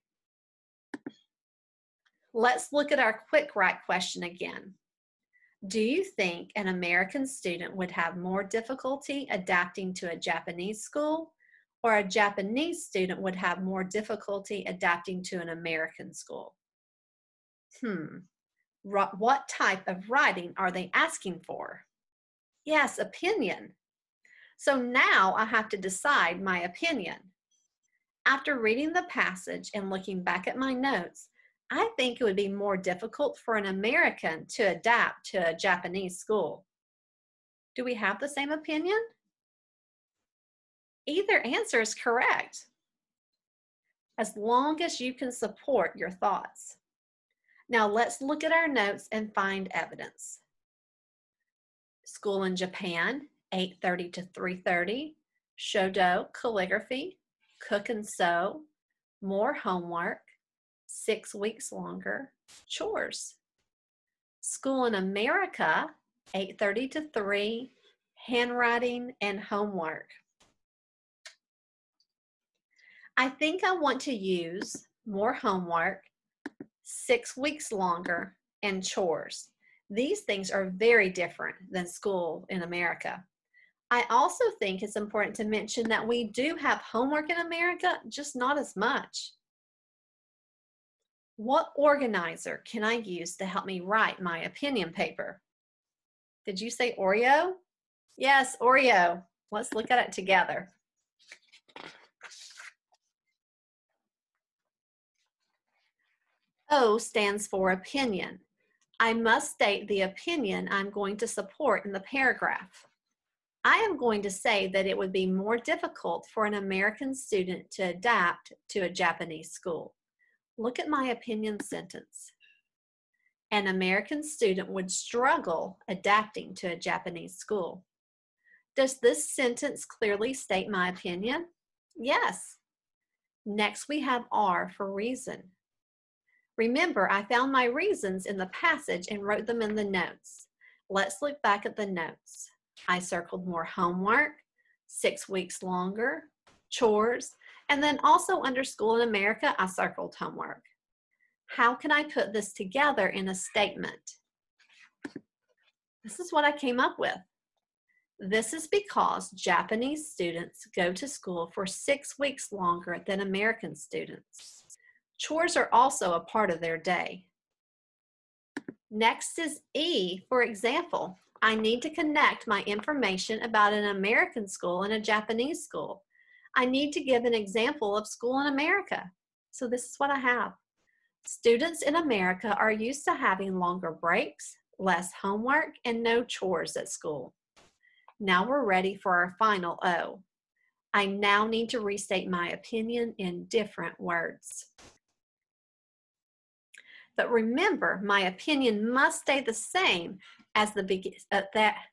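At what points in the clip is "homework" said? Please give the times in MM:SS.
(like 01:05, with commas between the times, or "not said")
00:59, 01:09, 01:15, 01:26, 02:23, 02:30, 03:05.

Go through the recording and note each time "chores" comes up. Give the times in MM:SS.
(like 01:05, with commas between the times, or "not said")
01:02, 01:18, 02:26, 02:45, 03:06.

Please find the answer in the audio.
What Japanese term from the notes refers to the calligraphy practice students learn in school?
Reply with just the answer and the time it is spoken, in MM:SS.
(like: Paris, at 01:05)
Shodo, at 00:55.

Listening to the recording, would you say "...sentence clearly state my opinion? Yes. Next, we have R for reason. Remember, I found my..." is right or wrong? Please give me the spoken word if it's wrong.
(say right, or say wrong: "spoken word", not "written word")
right.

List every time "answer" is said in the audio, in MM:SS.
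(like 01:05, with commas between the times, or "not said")
00:41.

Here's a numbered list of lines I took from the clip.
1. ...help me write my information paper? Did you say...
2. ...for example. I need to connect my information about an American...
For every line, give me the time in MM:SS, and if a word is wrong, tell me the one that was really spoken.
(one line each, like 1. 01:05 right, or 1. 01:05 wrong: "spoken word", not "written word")
1. 01:33 wrong: "opinion", not "information"
2. 02:50 right.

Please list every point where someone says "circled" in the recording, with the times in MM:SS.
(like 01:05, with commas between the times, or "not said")
02:22, 02:29.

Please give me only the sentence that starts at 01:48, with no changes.
I must state the opinion I'm going to support in the paragraph.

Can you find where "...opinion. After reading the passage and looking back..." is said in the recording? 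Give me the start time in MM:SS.
00:26.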